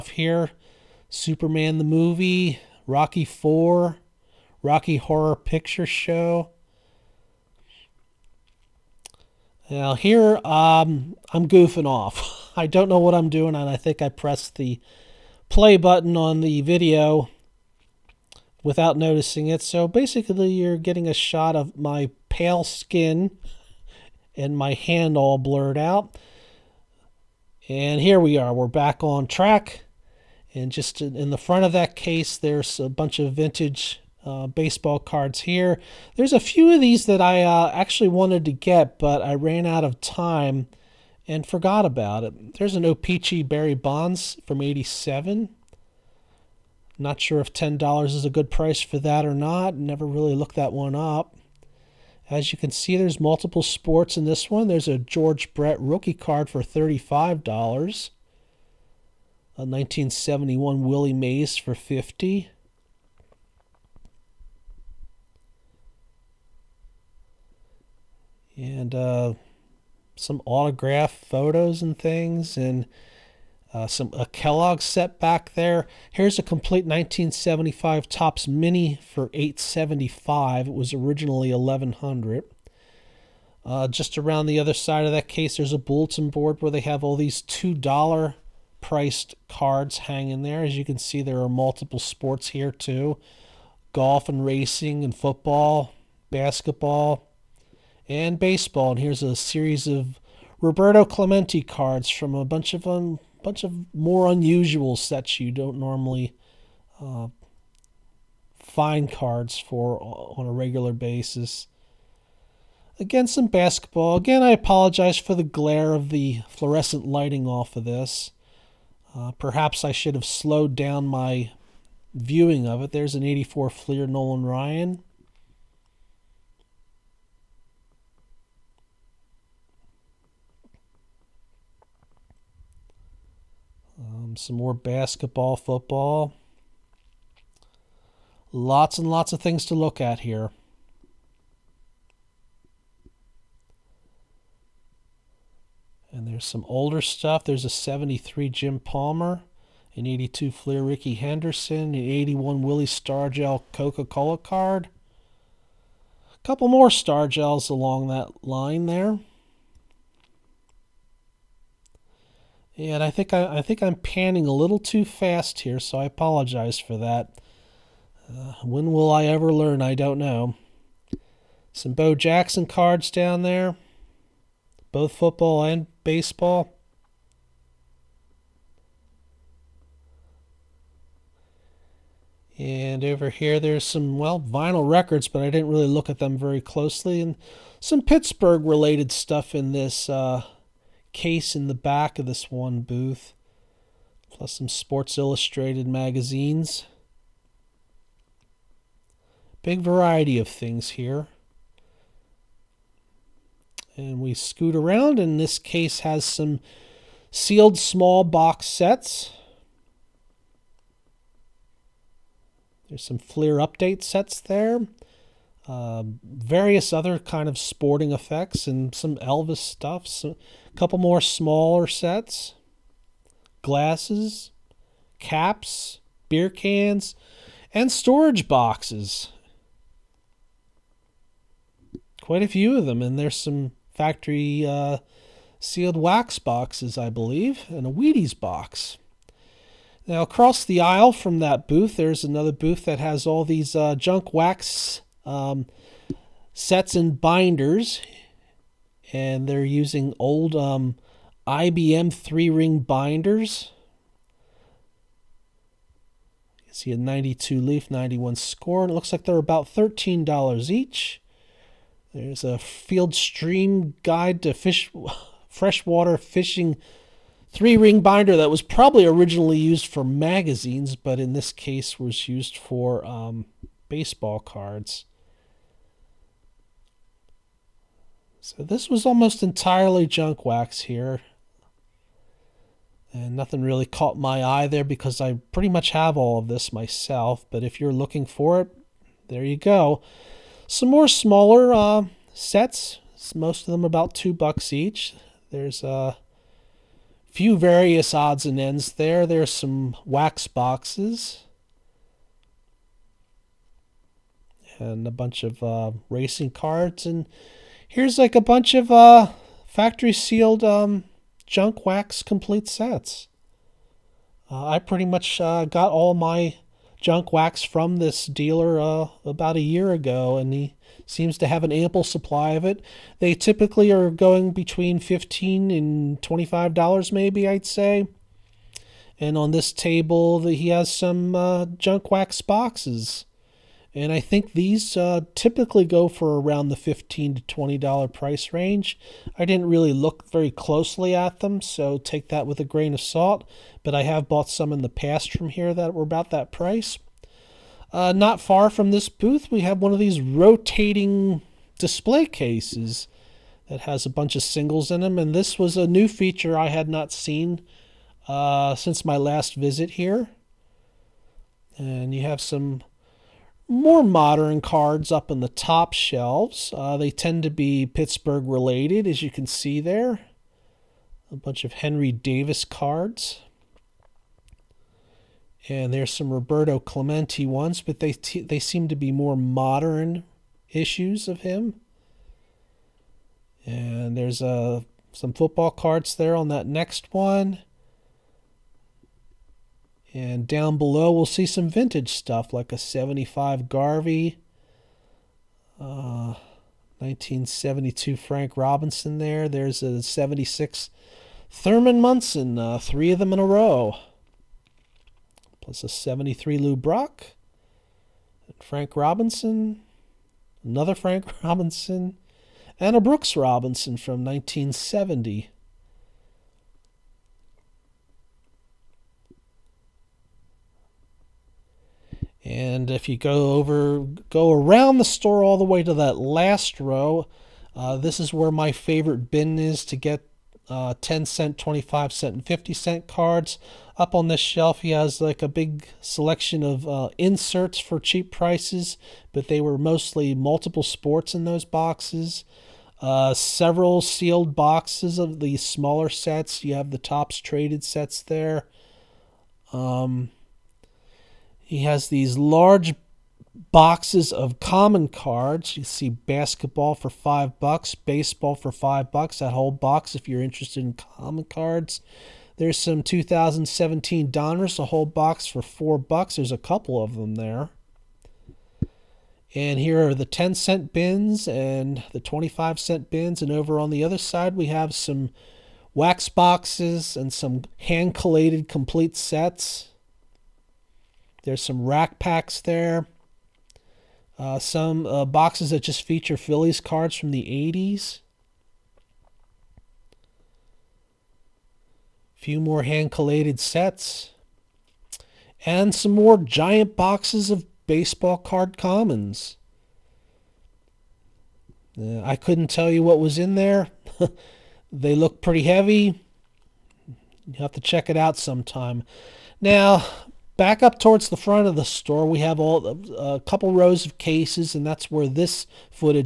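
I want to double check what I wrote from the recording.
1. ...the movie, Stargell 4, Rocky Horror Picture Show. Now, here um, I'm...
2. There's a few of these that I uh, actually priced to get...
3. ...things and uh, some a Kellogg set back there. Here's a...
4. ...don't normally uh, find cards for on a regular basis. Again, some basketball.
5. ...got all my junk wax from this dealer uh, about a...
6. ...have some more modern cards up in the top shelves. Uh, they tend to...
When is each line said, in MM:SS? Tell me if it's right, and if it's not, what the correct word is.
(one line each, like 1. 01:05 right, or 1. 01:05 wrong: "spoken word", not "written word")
1. 00:01 wrong: "Rocky", not "Stargell"
2. 00:36 wrong: "wanted", not "priced"
3. 01:11 right
4. 01:45 right
5. 05:15 right
6. 06:02 right.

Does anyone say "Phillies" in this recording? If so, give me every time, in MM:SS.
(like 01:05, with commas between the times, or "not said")
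08:06.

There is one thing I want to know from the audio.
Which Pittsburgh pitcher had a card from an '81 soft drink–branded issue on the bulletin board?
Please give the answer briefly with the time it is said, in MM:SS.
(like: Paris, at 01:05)
Willie Stargell, at 02:32.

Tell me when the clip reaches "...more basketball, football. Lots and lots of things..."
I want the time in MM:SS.
02:14.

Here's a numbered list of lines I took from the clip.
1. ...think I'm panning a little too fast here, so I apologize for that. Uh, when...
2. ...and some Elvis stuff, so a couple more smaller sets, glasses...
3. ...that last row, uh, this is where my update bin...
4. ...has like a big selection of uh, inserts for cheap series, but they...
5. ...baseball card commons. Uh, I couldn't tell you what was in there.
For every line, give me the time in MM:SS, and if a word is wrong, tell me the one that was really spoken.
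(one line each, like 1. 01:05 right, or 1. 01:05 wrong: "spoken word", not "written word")
1. 02:43 right
2. 03:38 right
3. 07:05 wrong: "favorite", not "update"
4. 07:14 wrong: "prices", not "series"
5. 08:17 right.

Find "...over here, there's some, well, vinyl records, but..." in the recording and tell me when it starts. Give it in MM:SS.
03:03.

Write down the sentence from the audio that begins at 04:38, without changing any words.
So this was almost entirely junk wax here.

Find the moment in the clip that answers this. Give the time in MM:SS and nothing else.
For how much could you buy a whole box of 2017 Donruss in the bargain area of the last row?
07:45.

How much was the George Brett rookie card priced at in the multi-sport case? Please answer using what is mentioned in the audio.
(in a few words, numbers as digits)
$35.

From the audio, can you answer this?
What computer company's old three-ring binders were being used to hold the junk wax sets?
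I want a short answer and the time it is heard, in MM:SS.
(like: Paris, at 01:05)
IBM, at 04:11.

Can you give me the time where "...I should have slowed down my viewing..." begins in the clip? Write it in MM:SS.
01:59.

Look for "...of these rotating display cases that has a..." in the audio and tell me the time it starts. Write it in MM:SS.
05:49.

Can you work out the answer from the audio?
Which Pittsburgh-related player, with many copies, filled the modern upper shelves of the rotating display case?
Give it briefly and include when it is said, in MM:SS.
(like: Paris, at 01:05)
Henry Davis, at 06:11.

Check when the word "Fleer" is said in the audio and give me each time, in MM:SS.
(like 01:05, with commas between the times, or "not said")
02:03, 02:30, 03:33.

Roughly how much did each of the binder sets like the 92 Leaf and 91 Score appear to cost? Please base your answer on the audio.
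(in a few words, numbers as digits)
$13.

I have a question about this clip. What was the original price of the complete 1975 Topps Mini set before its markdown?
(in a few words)
1100.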